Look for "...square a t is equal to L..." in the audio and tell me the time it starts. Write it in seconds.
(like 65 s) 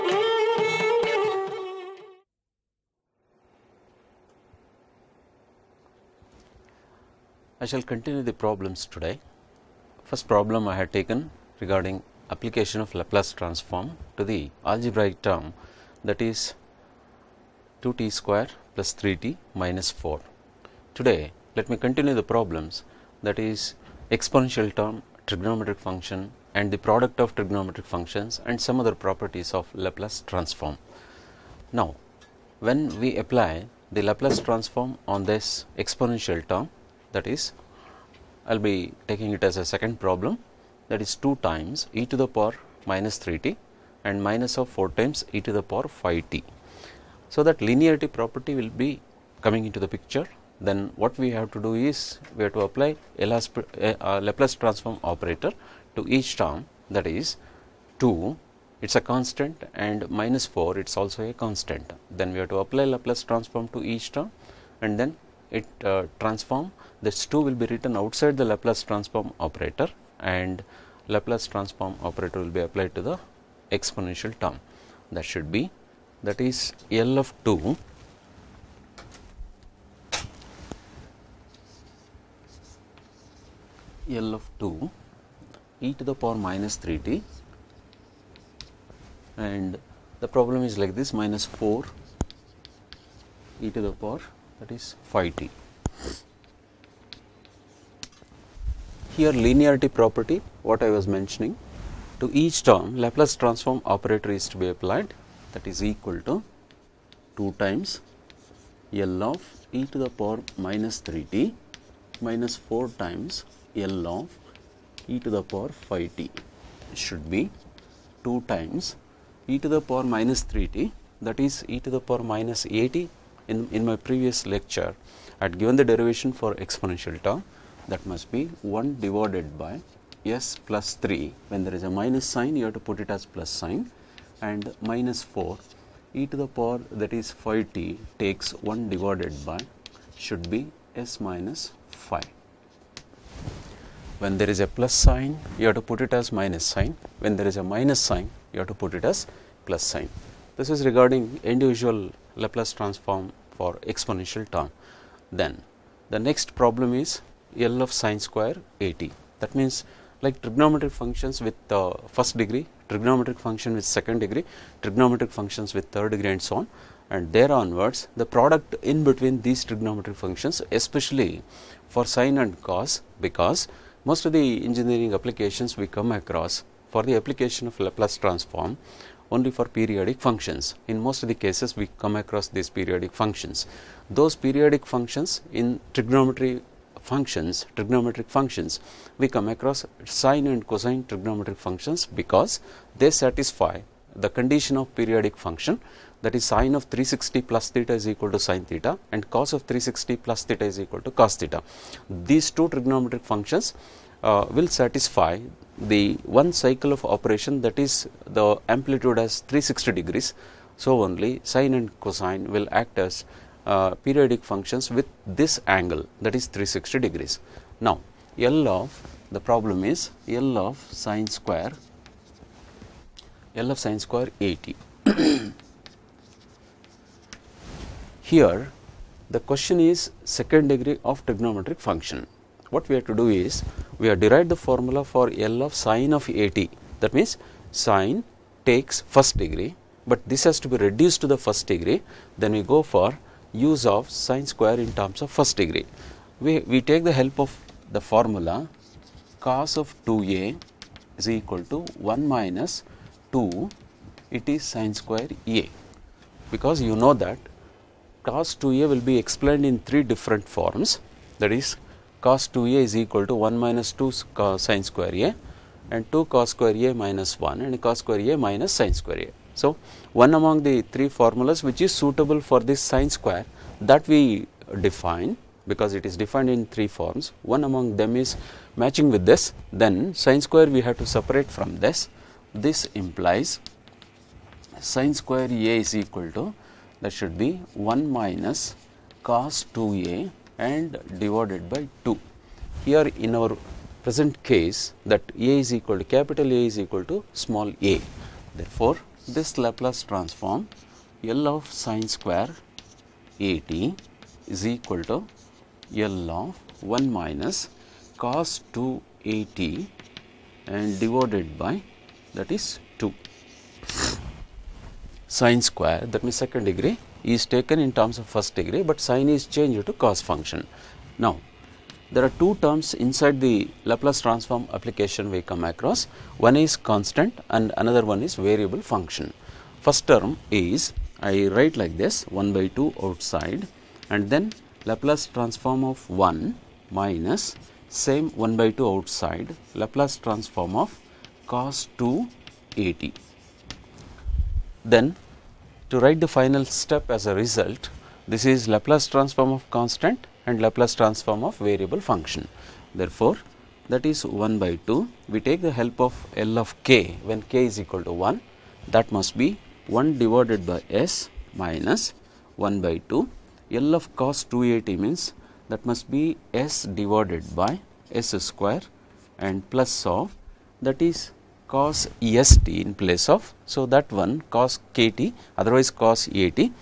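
302 s.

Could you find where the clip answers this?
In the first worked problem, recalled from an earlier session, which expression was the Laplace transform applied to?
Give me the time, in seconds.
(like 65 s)
17 s.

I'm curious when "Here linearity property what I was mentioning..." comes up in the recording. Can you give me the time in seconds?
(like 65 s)
99 s.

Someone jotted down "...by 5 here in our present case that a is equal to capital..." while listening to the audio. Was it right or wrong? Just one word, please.
wrong.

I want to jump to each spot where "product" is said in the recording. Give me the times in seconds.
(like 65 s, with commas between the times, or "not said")
26 s, 168 s.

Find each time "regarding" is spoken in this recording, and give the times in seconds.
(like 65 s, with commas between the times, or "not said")
11 s, 150 s.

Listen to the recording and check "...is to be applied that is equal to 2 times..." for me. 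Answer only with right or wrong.
right.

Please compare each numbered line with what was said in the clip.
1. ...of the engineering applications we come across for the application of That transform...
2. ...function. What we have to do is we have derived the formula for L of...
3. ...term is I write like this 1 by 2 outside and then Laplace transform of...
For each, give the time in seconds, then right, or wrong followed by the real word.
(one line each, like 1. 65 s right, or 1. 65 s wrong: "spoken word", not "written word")
1. 174 s wrong: "Laplace", not "That"
2. 231 s right
3. 330 s right.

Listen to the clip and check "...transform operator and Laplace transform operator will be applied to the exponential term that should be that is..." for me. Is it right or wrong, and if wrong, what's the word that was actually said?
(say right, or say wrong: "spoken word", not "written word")
right.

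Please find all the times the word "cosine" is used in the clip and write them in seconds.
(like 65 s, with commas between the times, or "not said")
190 s, 211 s.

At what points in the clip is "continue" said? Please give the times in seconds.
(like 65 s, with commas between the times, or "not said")
7 s, 21 s.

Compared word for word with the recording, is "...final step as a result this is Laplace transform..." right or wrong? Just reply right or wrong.
right.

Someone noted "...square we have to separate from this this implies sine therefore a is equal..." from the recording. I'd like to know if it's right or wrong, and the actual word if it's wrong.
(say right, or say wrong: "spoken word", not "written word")
wrong: "square", not "therefore".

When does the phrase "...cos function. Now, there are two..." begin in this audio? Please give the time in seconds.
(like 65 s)
319 s.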